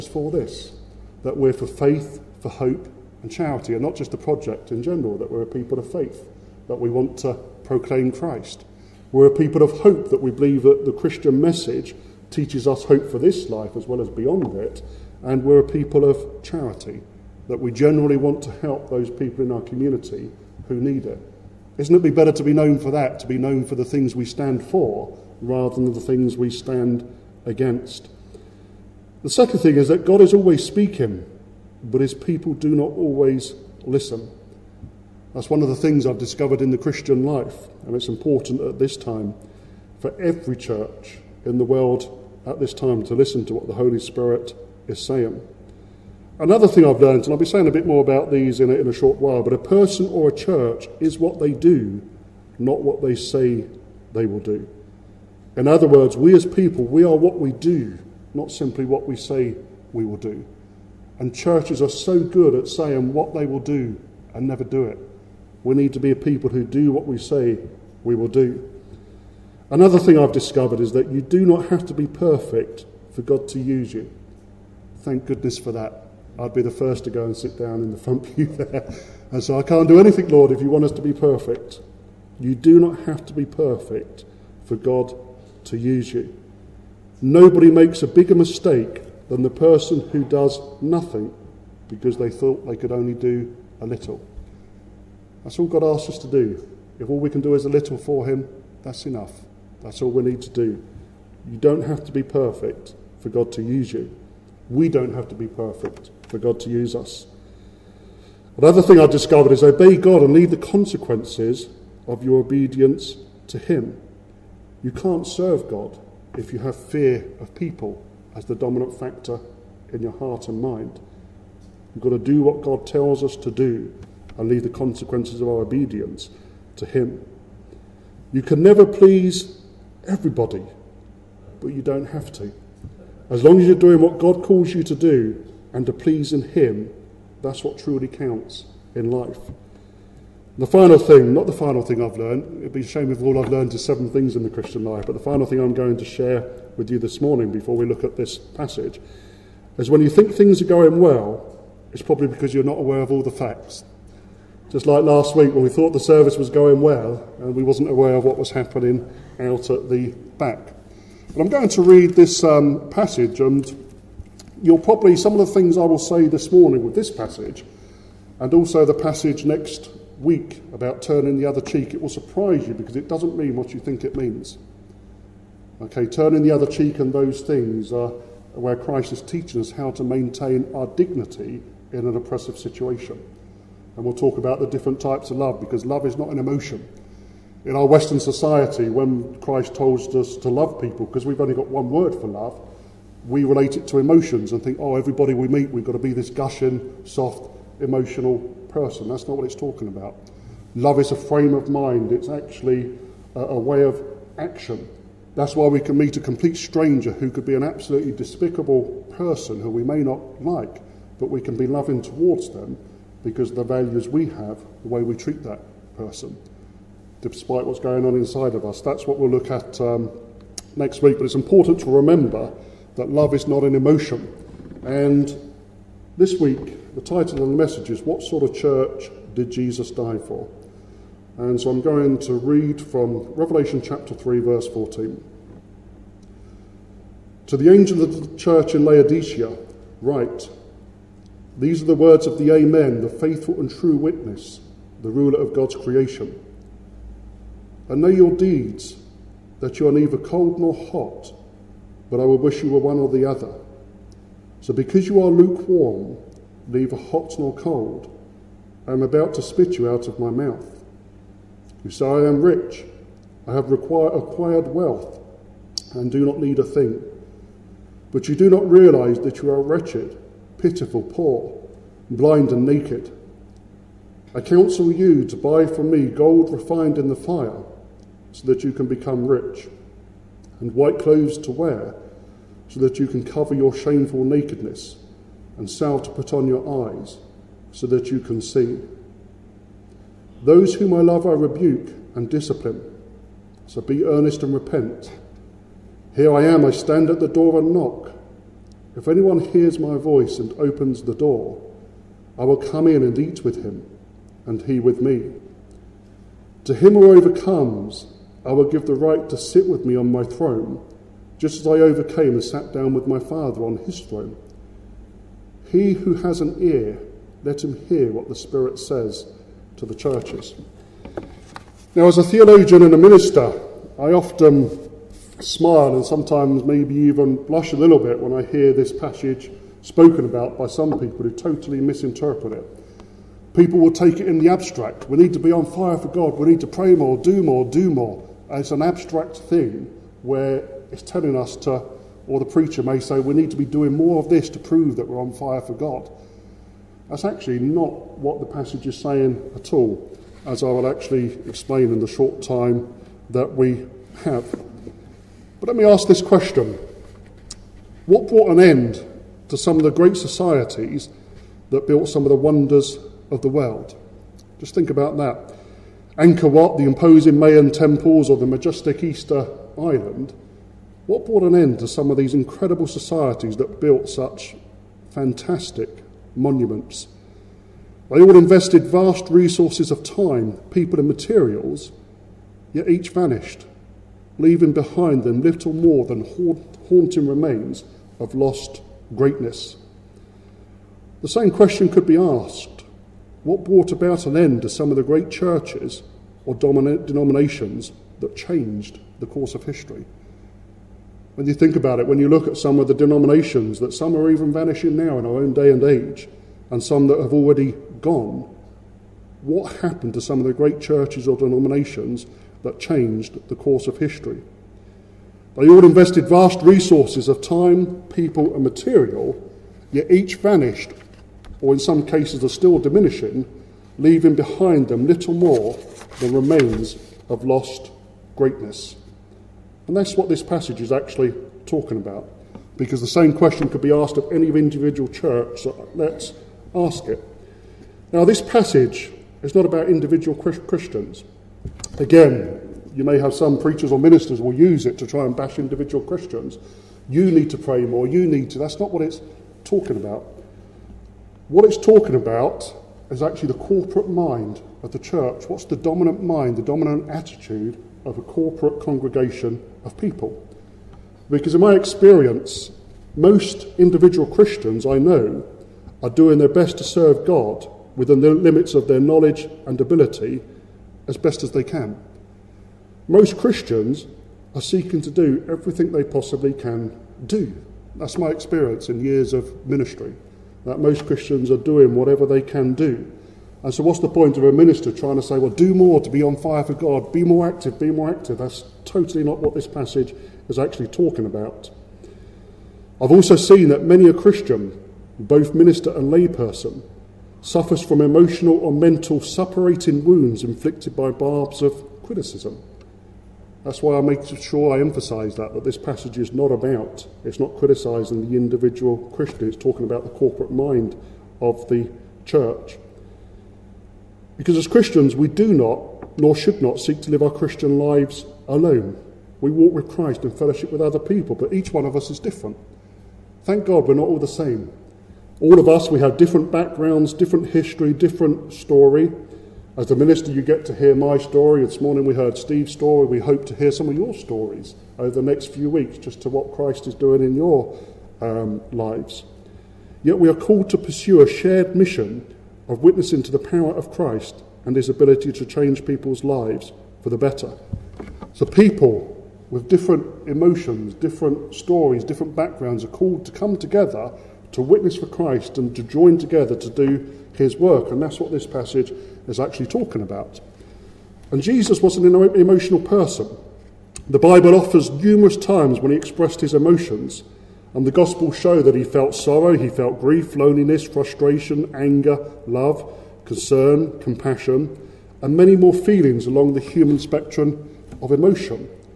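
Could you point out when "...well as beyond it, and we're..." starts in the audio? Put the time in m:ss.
0:13.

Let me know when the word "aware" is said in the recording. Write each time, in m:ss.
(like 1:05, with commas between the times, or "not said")
2:32, 2:37.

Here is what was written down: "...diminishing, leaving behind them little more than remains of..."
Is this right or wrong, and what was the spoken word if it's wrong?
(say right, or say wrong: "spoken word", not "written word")
right.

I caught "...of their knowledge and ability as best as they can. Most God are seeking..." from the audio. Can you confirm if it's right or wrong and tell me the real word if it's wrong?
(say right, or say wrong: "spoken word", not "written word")
wrong: "Christians", not "God".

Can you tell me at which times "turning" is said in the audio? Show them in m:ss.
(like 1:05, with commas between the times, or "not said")
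2:51, 2:56.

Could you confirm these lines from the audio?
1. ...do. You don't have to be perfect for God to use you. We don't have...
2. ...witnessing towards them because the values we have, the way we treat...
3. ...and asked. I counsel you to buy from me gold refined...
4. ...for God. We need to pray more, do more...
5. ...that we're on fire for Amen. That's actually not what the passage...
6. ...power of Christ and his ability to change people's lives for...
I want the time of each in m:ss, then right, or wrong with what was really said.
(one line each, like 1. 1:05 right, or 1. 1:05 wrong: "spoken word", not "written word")
1. 1:40 right
2. 3:31 wrong: "loving", not "witnessing"
3. 4:32 wrong: "naked", not "asked"
4. 5:35 right
5. 5:44 wrong: "God", not "Amen"
6. 9:03 right.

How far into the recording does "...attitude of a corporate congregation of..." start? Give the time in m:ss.
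7:37.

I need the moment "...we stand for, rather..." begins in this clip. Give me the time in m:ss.
0:24.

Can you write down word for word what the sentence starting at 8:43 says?
Thank God we're not all the same.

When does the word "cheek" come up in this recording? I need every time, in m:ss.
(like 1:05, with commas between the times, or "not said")
2:51, 2:56.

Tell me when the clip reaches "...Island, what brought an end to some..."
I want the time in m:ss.
6:09.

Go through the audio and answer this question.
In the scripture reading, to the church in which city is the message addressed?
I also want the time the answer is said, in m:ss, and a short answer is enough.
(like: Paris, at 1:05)
Laodicea, at 3:58.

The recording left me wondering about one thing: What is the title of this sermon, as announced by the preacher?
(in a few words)
What Sort of Church Did Jesus Die For?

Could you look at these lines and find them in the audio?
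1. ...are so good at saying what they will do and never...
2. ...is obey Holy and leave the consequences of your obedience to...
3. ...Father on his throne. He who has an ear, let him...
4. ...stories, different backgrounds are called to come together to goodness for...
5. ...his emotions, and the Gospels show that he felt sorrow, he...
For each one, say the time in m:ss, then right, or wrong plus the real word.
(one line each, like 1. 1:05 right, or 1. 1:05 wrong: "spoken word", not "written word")
1. 1:01 right
2. 1:49 wrong: "God", not "Holy"
3. 5:13 right
4. 9:11 wrong: "witness", not "goodness"
5. 9:26 right.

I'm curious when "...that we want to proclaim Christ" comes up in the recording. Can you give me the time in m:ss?
0:06.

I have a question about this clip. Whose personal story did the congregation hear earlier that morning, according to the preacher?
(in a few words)
Steve.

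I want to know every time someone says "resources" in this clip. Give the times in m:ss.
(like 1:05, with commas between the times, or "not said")
6:19, 6:56.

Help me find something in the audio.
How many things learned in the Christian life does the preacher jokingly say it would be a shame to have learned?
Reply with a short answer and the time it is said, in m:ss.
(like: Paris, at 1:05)
7, at 2:23.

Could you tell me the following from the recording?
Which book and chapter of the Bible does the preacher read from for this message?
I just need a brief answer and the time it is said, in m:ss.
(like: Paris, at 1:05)
Revelation chapter 3, at 3:53.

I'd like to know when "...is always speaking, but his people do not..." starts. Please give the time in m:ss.
0:30.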